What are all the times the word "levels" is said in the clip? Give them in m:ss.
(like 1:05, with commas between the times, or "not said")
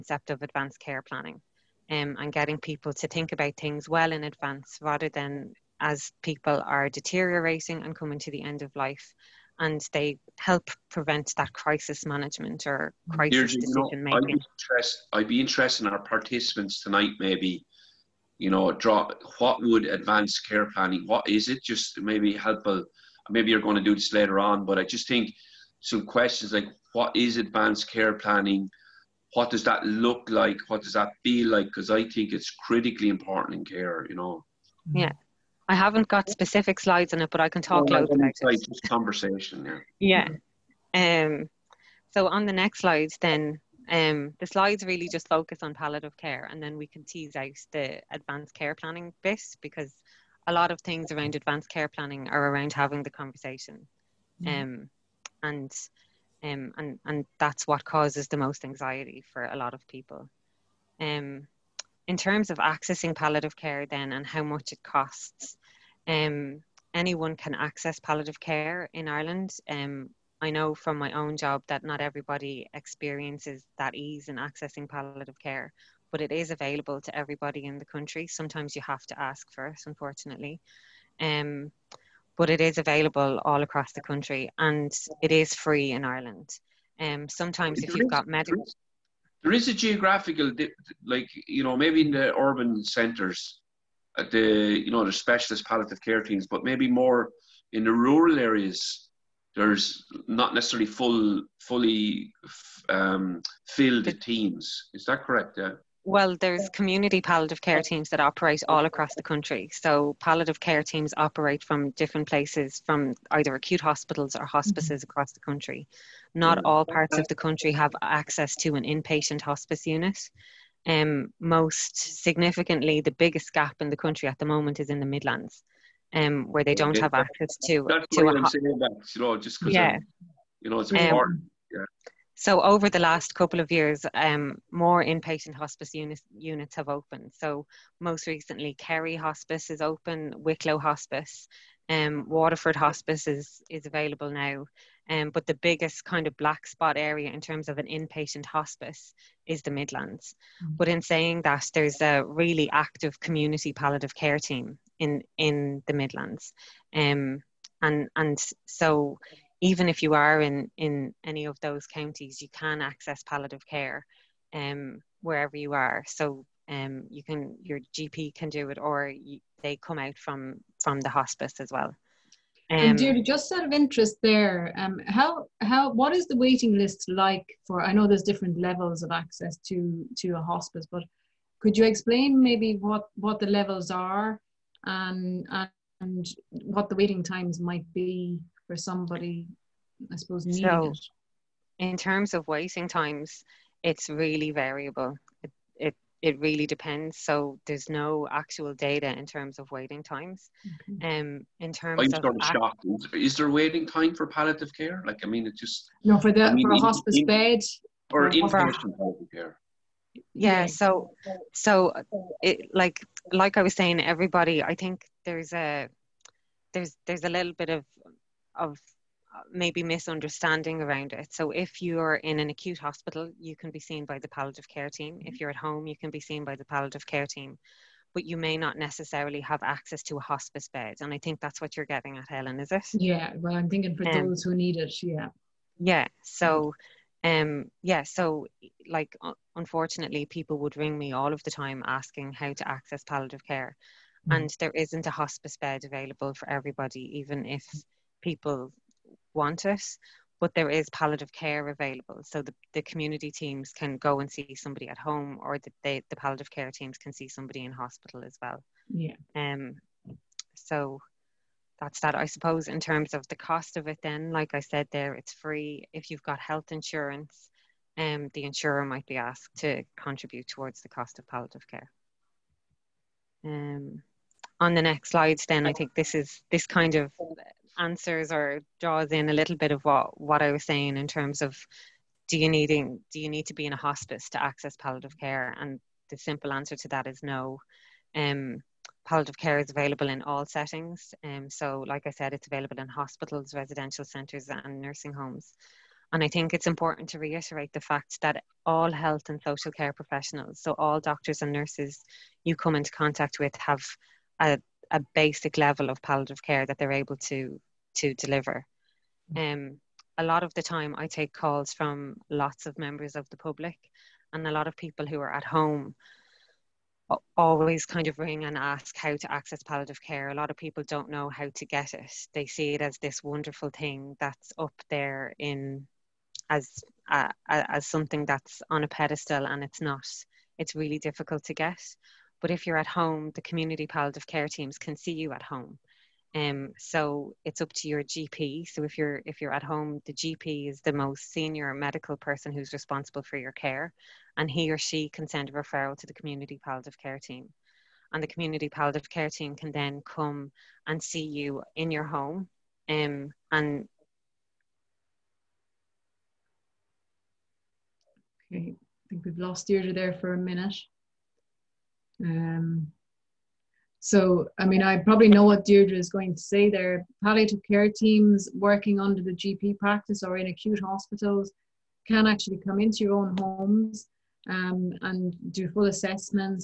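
2:58, 3:03, 5:05.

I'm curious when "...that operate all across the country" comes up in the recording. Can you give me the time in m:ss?
1:48.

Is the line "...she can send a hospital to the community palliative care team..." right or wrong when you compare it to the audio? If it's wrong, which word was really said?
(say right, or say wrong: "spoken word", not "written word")
wrong: "referral", not "hospital".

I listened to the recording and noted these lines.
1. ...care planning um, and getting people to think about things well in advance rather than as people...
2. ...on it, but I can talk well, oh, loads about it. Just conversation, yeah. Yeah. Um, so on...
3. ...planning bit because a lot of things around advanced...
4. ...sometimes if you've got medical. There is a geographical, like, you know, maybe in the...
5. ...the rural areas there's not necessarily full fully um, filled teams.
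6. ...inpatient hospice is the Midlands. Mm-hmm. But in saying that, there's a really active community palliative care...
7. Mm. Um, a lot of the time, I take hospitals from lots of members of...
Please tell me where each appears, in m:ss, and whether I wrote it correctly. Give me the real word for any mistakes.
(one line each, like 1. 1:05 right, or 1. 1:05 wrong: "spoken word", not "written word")
1. 0:00 right
2. 0:37 right
3. 0:48 right
4. 1:27 right
5. 1:37 right
6. 2:27 right
7. 5:09 wrong: "calls", not "hospitals".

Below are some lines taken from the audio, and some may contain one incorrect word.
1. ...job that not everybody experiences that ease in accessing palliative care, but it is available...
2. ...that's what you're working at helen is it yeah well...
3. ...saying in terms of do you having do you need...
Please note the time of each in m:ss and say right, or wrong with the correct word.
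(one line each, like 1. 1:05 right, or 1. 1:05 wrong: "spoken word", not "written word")
1. 1:11 right
2. 3:51 wrong: "getting", not "working"
3. 4:40 wrong: "needing", not "having".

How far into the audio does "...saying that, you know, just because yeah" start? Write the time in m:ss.
2:08.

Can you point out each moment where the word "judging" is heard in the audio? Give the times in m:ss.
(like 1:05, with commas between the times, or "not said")
not said.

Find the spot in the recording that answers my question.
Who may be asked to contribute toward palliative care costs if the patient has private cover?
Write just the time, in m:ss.
4:28.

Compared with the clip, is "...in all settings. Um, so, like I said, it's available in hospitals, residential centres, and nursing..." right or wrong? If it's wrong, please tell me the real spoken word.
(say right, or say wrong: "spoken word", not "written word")
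right.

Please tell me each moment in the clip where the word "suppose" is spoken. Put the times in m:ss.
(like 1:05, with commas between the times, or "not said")
3:10, 4:22.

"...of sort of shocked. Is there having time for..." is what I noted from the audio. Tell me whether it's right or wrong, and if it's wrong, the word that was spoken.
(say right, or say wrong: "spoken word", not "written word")
wrong: "waiting", not "having".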